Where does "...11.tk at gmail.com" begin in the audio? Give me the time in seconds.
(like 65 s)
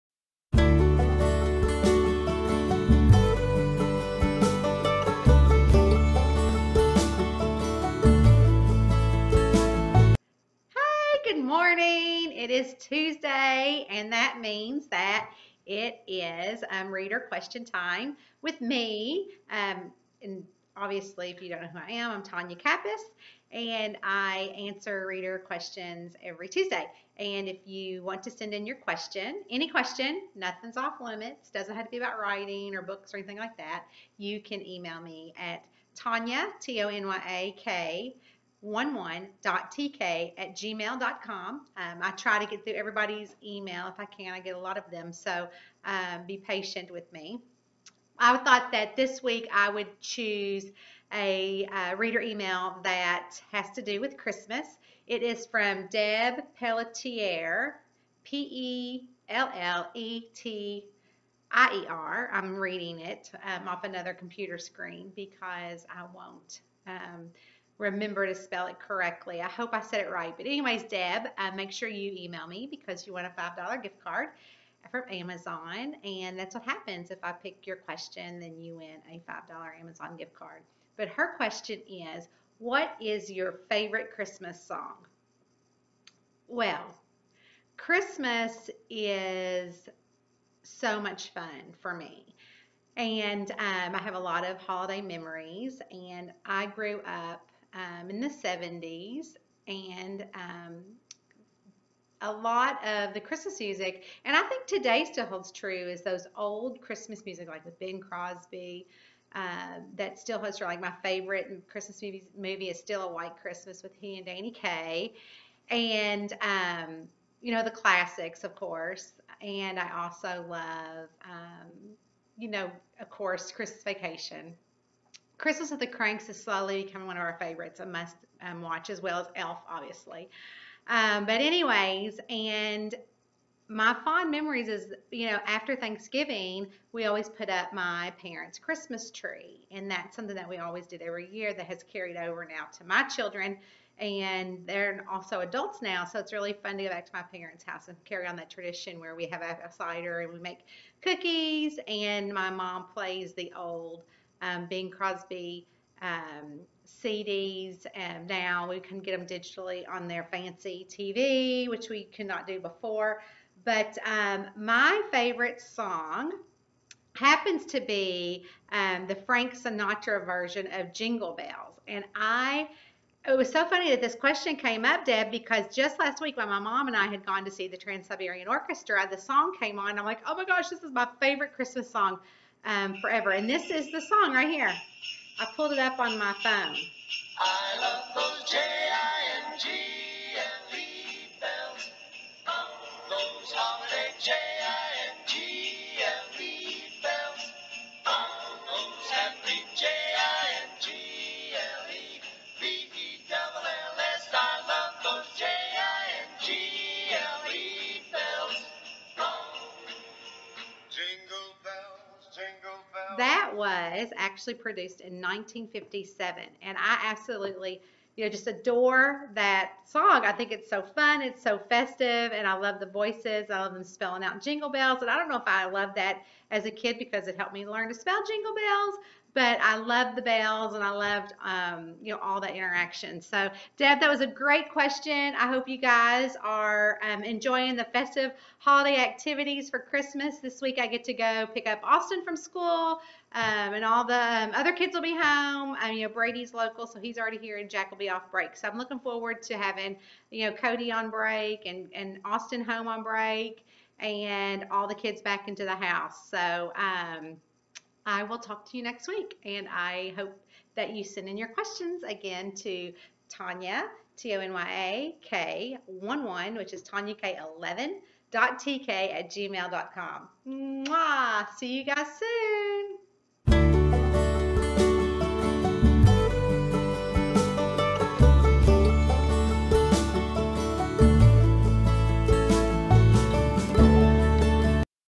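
38 s.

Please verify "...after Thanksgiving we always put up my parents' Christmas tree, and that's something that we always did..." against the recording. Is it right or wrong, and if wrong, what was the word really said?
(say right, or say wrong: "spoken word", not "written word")
right.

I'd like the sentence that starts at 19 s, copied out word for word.
Um, and obviously, if you don't know who I am, I'm Tonya Kappes, and I answer reader questions every Tuesday.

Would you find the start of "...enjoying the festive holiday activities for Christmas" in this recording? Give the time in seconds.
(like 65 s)
237 s.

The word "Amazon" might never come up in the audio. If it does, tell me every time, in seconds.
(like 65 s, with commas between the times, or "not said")
75 s, 79 s.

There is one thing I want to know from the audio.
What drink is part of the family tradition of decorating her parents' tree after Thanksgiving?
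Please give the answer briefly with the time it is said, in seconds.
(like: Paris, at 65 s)
cider, at 149 s.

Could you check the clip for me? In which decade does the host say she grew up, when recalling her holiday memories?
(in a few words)
70s.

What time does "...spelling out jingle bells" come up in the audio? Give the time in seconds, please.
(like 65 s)
223 s.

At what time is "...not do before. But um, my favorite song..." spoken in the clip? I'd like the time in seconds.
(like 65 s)
162 s.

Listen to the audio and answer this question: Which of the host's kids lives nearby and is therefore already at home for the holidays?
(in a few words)
Brady.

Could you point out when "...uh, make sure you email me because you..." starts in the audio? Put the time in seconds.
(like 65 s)
71 s.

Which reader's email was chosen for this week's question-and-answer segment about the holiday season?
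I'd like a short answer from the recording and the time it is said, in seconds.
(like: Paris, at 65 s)
Deb Pelletier, at 55 s.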